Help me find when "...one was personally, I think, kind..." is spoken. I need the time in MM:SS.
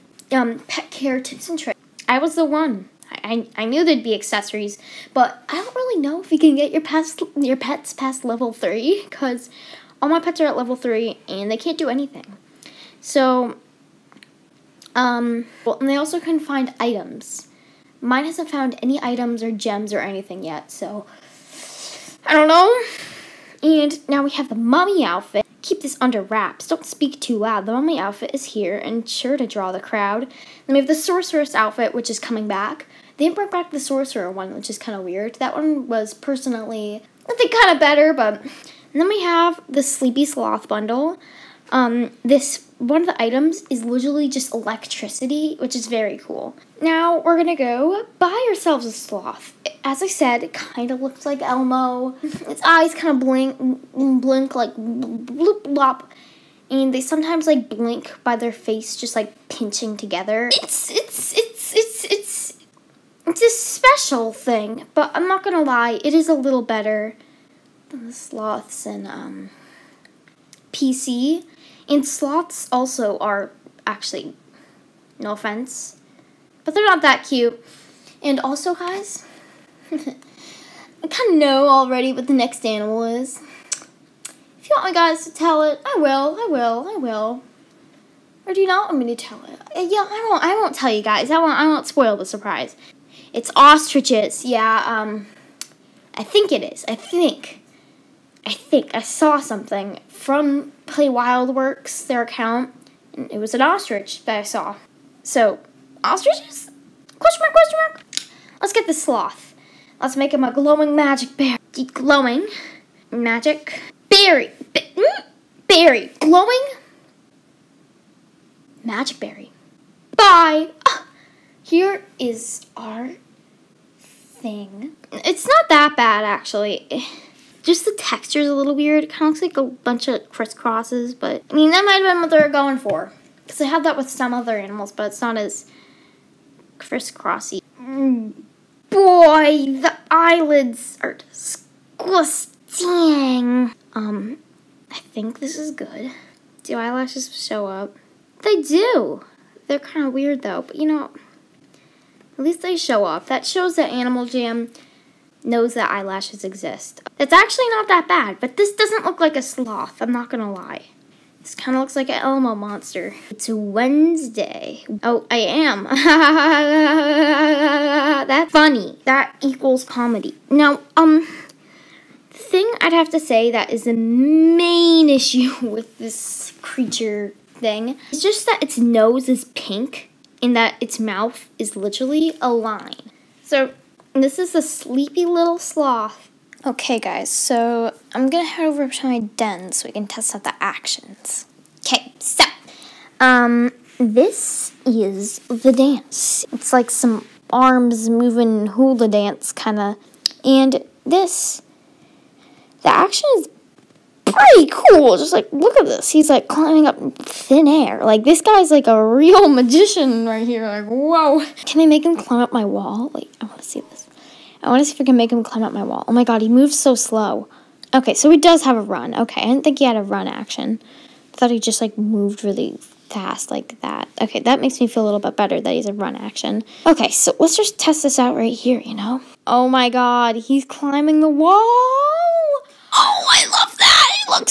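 00:35.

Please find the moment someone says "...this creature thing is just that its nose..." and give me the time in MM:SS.
02:55.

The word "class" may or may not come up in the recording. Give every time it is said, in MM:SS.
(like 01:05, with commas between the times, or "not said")
not said.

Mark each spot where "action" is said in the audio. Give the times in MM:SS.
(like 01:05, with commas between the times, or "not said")
03:10, 03:22, 03:40, 03:46.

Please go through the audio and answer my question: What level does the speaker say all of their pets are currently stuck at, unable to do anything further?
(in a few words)
3.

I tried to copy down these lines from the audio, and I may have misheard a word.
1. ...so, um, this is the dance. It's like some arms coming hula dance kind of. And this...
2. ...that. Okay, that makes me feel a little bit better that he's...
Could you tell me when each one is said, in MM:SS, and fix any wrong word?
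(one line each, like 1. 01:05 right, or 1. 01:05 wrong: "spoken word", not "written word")
1. 03:12 wrong: "moving", not "coming"
2. 03:43 right.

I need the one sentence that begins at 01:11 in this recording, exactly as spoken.
And sloths also are actually, no offense, but they're not that cute.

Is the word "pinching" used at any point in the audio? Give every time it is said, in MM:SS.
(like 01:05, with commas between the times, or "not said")
00:59.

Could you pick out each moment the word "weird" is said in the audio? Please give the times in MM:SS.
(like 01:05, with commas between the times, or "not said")
00:35, 02:08, 02:30.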